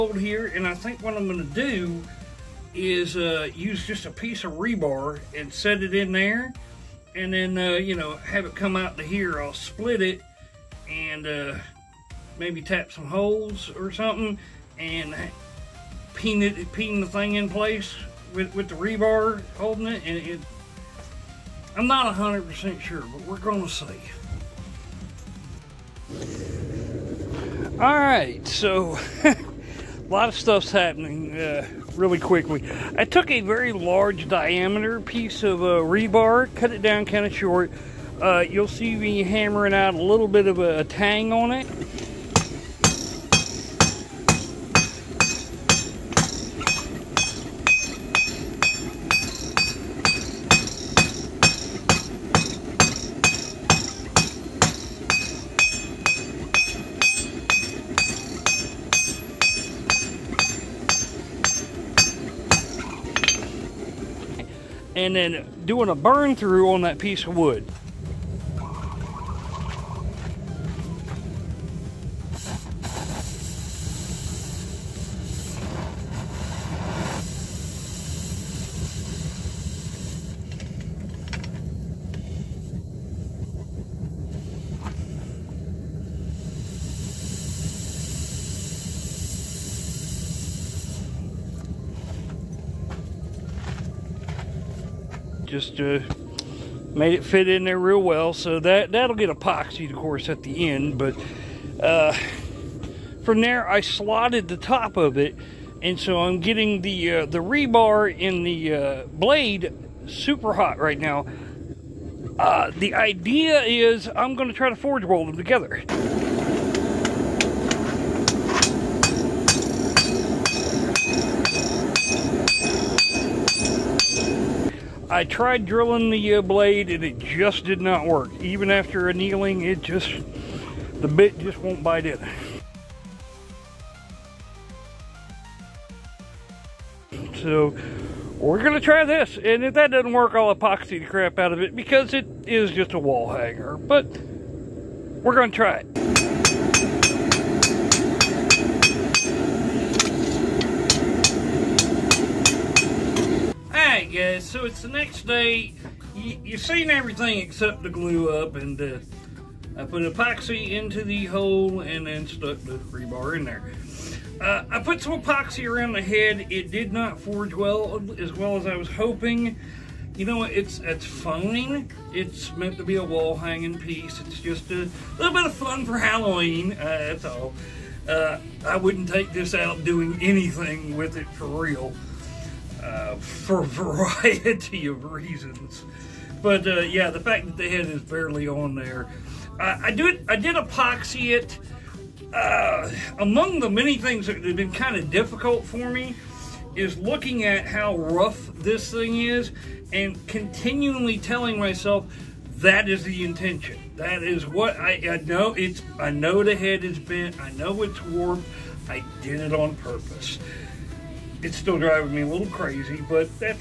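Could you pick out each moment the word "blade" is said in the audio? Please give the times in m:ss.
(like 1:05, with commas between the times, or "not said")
1:49, 2:06.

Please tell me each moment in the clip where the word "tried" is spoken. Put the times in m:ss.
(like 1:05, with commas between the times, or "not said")
2:05.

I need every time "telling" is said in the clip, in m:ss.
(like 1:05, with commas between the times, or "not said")
3:21.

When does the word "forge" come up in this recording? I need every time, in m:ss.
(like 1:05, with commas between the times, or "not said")
1:54, 2:47.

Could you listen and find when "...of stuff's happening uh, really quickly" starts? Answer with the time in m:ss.
0:30.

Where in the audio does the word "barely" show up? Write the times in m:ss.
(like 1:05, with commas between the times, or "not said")
3:08.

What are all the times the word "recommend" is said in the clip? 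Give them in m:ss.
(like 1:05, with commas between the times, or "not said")
not said.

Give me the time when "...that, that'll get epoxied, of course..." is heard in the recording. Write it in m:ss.
1:38.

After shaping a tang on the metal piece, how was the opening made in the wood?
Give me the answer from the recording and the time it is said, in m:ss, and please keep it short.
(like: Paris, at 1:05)
burn through, at 1:05.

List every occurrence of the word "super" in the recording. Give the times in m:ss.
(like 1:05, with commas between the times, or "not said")
1:50.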